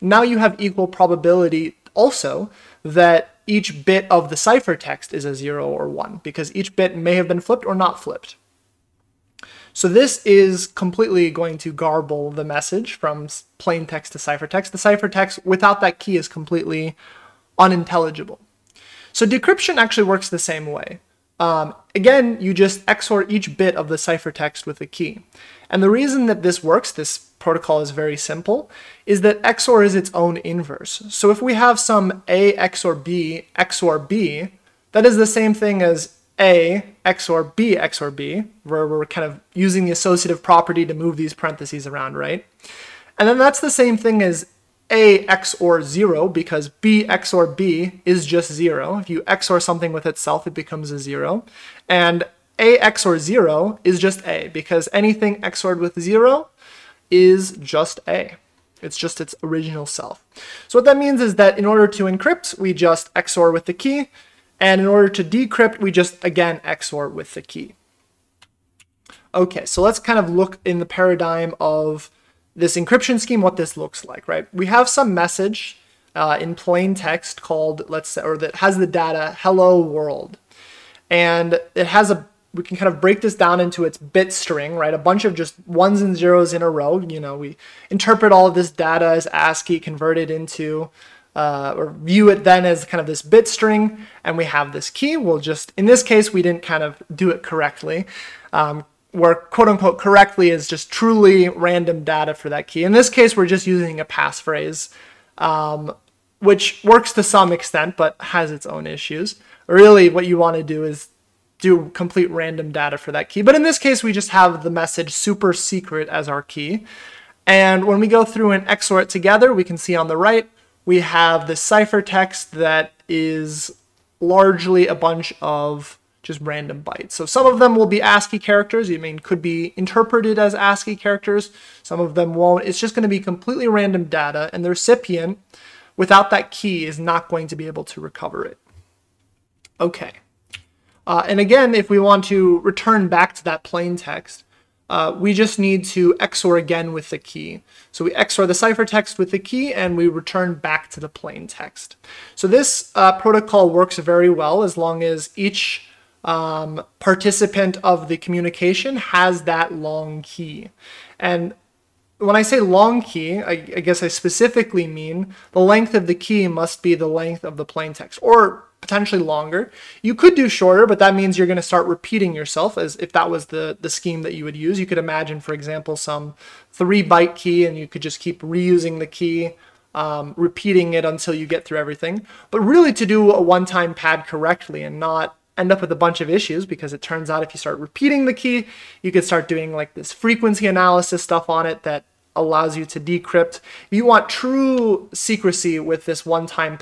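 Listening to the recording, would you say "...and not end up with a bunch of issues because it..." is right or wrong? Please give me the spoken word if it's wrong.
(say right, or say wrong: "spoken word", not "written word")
right.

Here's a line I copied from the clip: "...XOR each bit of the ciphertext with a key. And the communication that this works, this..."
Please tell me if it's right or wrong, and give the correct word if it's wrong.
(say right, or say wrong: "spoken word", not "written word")
wrong: "reason", not "communication".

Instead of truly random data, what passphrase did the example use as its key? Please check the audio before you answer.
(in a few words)
super secret.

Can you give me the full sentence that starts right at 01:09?
Okay, so let's kind of look in the paradigm of this encryption scheme, what this looks like, right?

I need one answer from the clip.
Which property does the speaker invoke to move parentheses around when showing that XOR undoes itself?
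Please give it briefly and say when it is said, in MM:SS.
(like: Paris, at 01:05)
associative property, at 00:39.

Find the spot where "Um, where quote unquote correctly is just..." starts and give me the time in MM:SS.
01:38.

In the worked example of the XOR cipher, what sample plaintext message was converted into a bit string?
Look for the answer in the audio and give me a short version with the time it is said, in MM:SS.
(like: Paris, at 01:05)
hello world, at 01:19.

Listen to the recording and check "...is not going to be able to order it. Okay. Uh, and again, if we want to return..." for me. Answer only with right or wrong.
wrong.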